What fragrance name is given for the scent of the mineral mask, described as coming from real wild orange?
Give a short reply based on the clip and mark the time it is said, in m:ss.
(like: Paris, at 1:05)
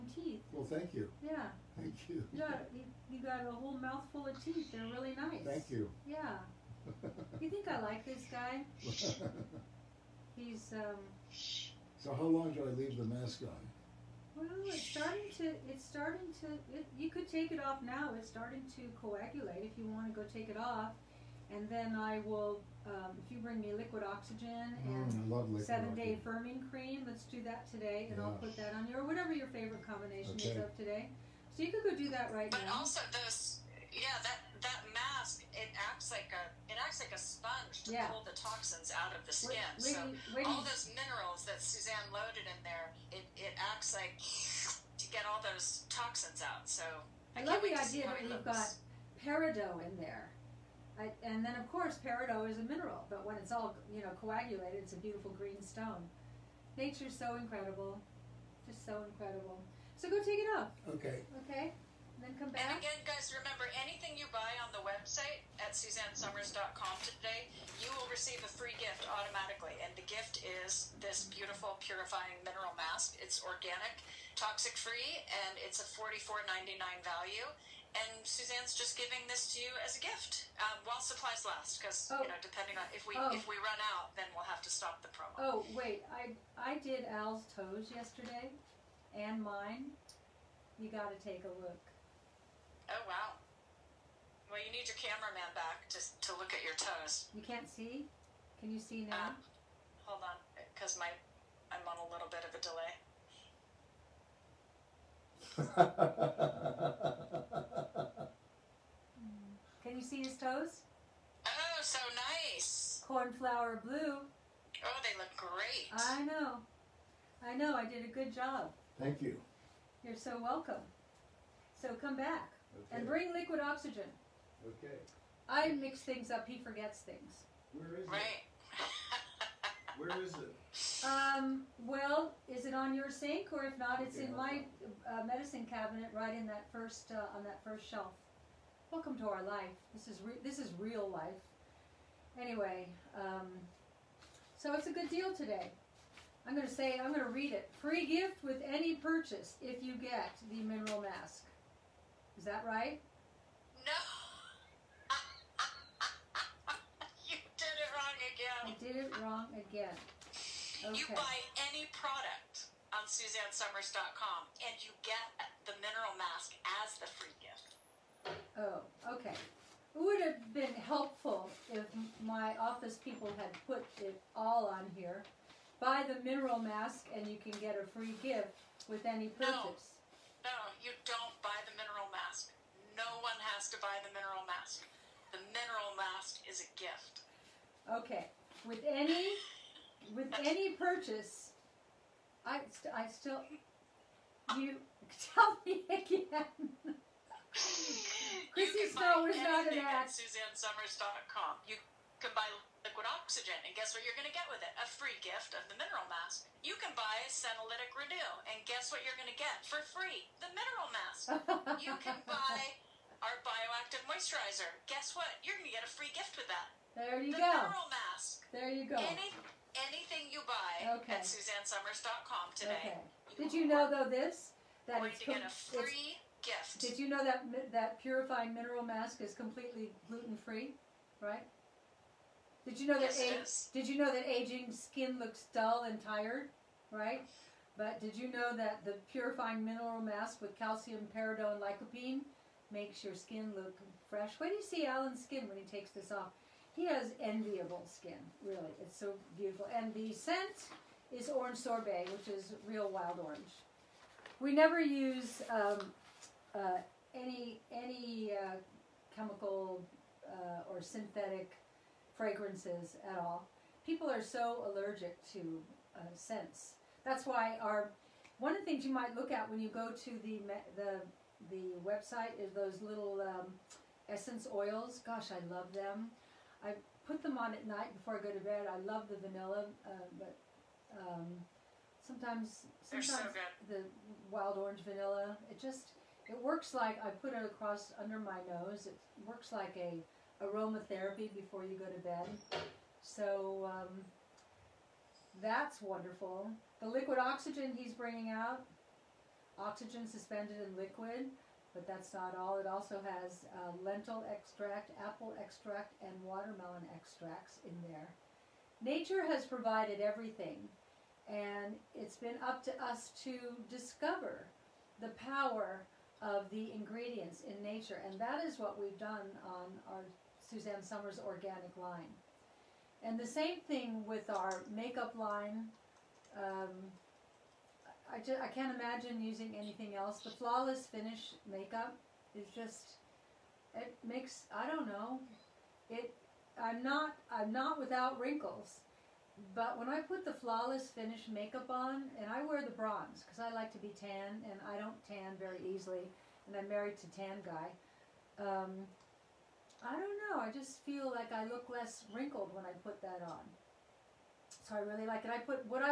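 Orange sorbet, at 4:11.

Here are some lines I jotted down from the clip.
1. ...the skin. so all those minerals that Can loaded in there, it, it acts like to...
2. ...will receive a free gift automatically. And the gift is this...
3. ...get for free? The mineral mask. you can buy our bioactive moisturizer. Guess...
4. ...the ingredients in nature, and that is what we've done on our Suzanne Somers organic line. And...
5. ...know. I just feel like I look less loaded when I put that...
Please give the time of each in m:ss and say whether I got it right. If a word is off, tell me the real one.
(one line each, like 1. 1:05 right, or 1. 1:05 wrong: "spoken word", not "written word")
1. 0:39 wrong: "Suzanne", not "Can"
2. 1:07 right
3. 3:29 right
4. 5:16 right
5. 5:50 wrong: "wrinkled", not "loaded".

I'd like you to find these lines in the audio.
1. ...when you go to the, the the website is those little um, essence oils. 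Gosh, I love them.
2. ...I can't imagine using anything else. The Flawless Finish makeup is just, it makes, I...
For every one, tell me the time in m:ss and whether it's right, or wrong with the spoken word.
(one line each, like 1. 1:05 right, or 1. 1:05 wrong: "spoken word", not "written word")
1. 4:29 right
2. 5:28 right.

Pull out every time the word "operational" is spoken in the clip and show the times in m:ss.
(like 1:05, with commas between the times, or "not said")
not said.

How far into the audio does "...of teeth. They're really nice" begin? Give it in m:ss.
0:04.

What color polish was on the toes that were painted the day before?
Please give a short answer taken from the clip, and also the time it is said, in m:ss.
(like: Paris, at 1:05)
Cornflower blue, at 1:53.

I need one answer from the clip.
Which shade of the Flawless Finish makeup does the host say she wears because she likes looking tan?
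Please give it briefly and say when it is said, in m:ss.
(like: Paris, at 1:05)
Bronze, at 5:42.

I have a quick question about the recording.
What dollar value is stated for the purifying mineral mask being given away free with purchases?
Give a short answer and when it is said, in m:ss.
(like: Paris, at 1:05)
$44.99, at 1:15.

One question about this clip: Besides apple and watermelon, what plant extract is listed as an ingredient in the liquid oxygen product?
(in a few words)
Lentil.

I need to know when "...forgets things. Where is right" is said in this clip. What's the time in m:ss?
2:06.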